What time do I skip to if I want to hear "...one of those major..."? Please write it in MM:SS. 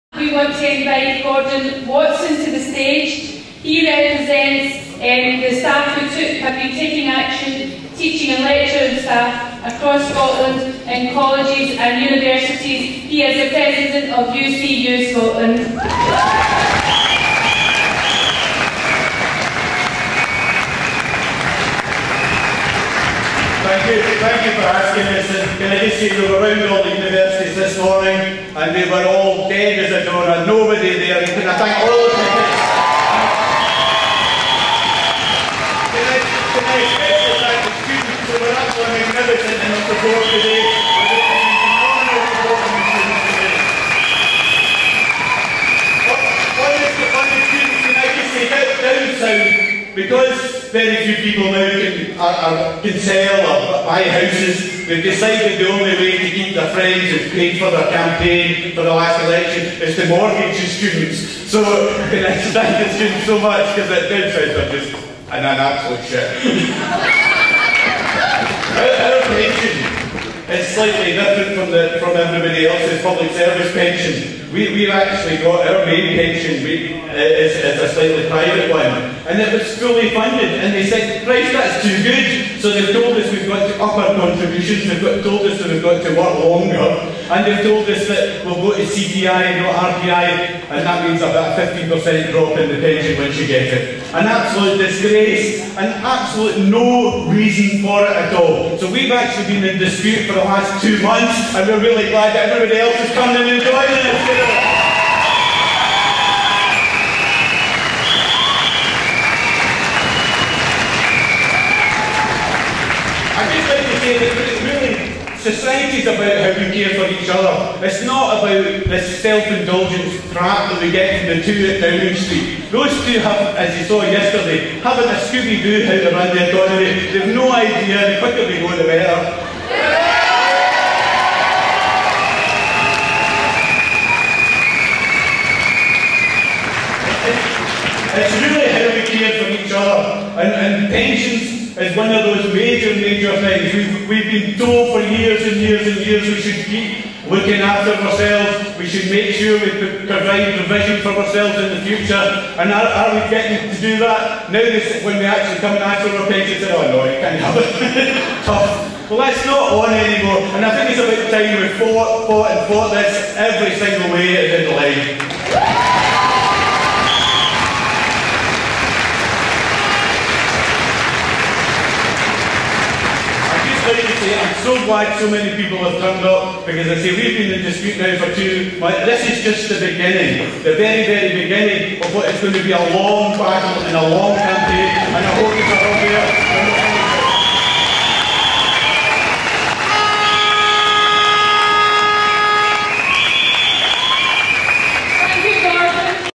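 02:21.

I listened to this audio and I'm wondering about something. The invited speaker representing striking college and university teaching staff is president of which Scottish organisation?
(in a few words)
UCU Scotland.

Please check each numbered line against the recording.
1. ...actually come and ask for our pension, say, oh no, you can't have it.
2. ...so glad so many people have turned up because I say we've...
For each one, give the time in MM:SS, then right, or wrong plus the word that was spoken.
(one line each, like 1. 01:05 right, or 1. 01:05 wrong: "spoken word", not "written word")
1. 02:35 right
2. 02:54 right.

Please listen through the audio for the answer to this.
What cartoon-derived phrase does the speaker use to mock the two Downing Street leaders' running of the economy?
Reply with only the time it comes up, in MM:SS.
02:05.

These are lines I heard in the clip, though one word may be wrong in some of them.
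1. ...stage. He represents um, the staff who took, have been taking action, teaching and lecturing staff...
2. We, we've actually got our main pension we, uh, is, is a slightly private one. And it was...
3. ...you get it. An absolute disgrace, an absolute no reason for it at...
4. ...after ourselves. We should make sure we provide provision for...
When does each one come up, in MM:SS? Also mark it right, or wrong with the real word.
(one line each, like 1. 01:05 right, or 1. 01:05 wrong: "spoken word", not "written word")
1. 00:02 right
2. 01:14 right
3. 01:33 right
4. 02:27 right.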